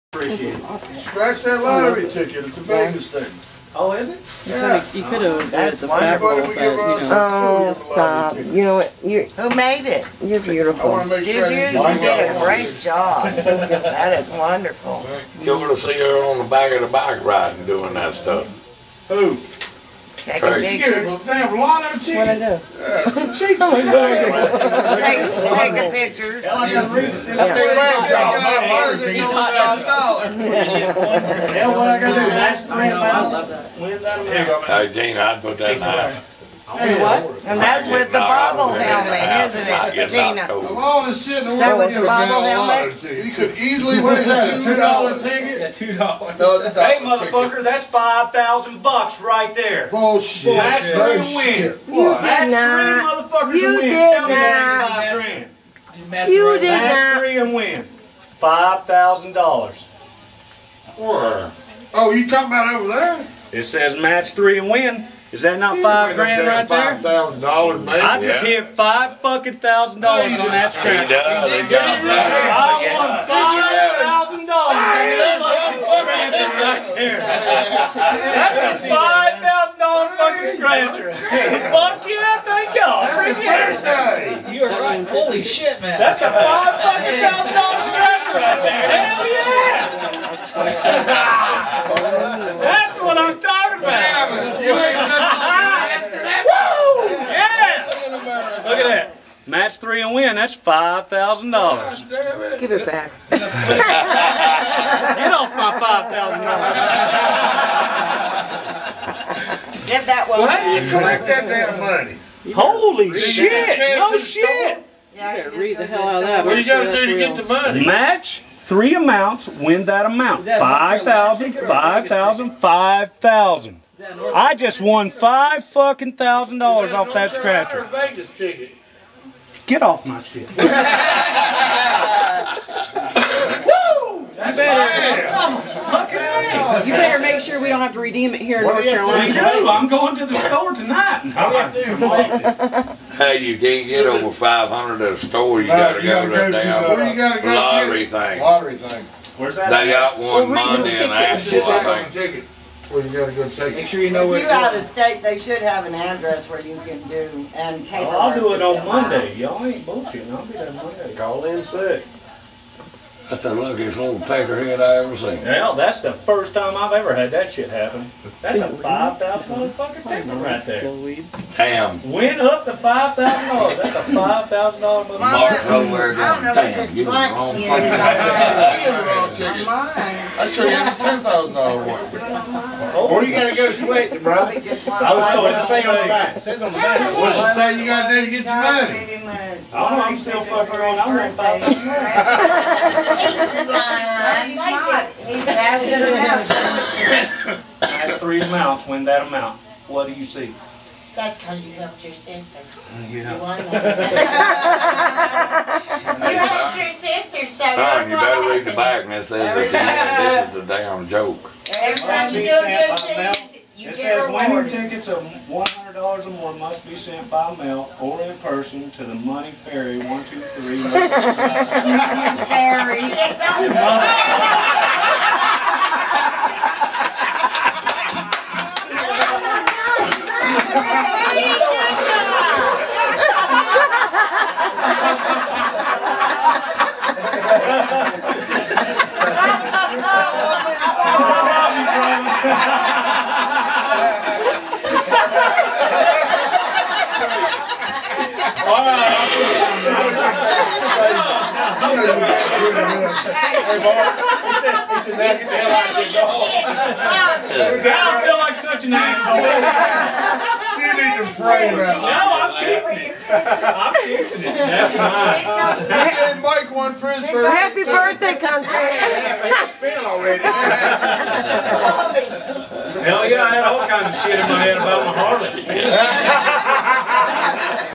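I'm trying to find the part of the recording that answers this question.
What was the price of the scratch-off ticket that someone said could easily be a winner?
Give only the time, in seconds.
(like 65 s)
44 s.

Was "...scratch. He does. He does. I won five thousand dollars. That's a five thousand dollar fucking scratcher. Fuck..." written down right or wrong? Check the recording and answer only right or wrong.
right.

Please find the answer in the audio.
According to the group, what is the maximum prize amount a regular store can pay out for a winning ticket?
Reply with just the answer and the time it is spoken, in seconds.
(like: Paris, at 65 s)
500, at 144 s.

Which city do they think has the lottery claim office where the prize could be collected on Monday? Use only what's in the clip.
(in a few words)
Asheville.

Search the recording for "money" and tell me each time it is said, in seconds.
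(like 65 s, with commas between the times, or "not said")
111 s, 117 s, 188 s, 219 s, 223 s.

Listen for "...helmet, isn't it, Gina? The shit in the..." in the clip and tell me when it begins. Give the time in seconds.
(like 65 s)
38 s.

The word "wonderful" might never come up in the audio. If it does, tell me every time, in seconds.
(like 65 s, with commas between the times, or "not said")
6 s, 14 s.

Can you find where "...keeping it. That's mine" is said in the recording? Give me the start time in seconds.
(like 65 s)
263 s.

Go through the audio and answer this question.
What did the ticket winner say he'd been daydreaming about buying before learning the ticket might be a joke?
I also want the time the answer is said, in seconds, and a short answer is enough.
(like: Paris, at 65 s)
Harley, at 275 s.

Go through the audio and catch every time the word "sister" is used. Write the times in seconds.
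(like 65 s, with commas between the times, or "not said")
202 s, 206 s.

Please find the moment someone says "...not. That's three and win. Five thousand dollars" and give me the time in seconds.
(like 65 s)
56 s.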